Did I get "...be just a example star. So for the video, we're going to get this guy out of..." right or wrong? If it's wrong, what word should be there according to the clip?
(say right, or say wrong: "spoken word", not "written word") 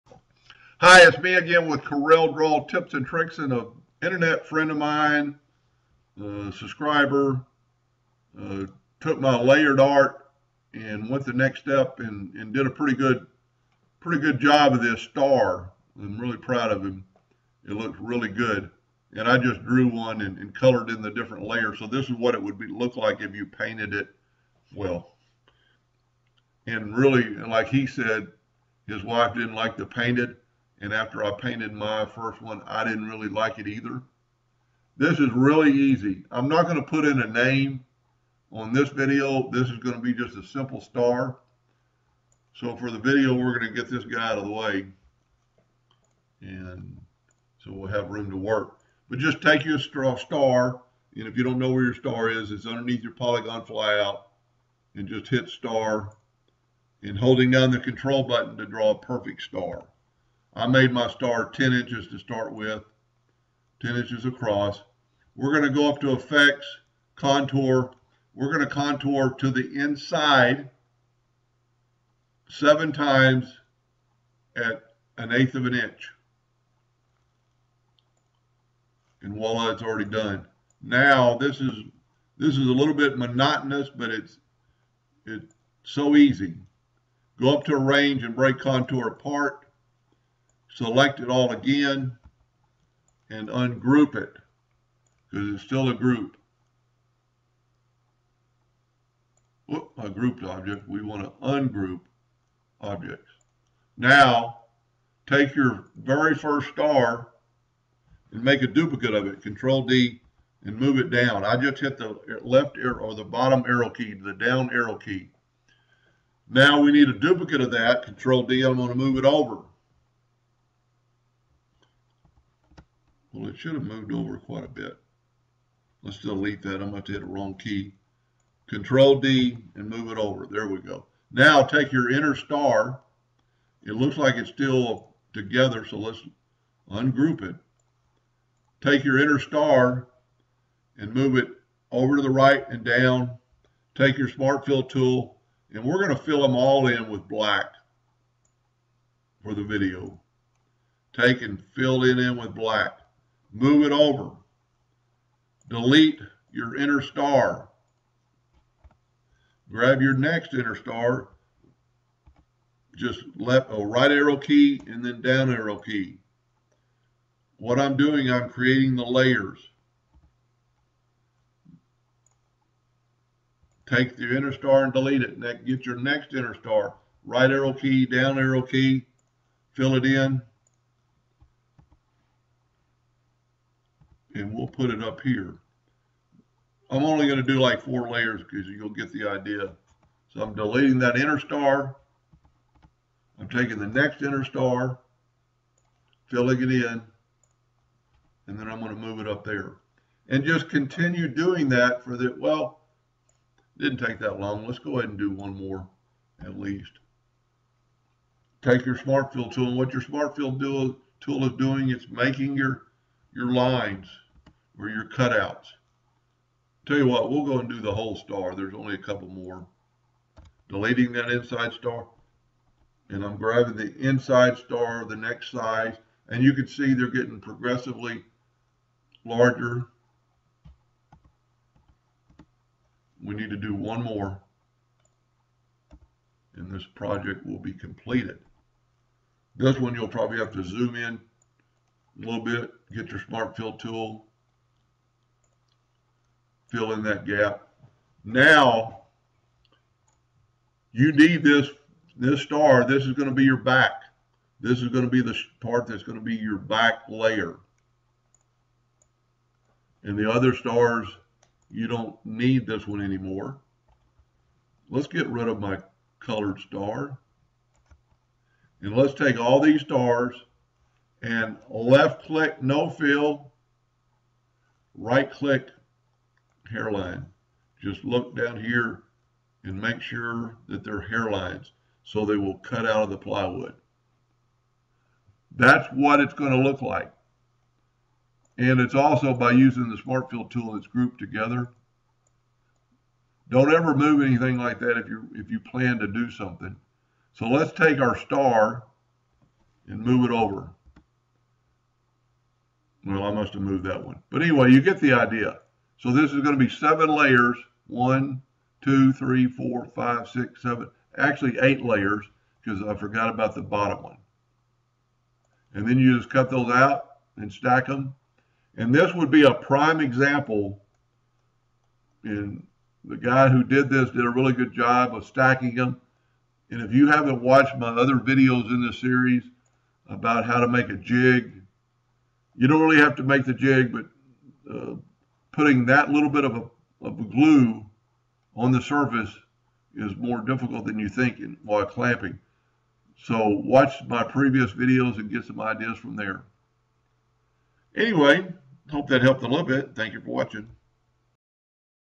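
wrong: "simple", not "example".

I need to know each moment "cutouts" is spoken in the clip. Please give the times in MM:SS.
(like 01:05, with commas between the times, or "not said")
03:35.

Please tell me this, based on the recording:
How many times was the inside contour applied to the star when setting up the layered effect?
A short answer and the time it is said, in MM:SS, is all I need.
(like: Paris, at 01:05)
7, at 01:12.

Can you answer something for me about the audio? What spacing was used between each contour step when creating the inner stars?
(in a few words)
1/8 inch.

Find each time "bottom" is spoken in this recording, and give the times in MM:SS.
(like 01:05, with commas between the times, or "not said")
01:53, 05:13.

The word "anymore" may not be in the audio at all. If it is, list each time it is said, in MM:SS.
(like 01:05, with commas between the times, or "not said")
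04:23.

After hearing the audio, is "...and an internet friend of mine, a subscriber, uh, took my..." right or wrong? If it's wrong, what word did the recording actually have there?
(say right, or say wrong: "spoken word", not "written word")
right.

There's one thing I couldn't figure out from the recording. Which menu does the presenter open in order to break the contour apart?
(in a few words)
Arrange.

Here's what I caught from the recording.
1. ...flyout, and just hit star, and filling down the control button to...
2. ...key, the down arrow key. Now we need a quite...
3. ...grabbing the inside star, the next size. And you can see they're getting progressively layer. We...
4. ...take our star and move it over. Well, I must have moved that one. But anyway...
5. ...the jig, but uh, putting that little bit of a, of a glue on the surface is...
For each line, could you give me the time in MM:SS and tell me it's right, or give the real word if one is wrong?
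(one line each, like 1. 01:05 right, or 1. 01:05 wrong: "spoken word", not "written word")
1. 00:53 wrong: "holding", not "filling"
2. 01:53 wrong: "duplicate", not "quite"
3. 03:43 wrong: "larger", not "layer"
4. 04:57 right
5. 05:33 right.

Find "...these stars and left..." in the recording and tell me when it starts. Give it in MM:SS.
04:29.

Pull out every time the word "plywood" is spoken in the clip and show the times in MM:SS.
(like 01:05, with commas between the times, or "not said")
04:43.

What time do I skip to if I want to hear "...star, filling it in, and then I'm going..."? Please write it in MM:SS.
03:14.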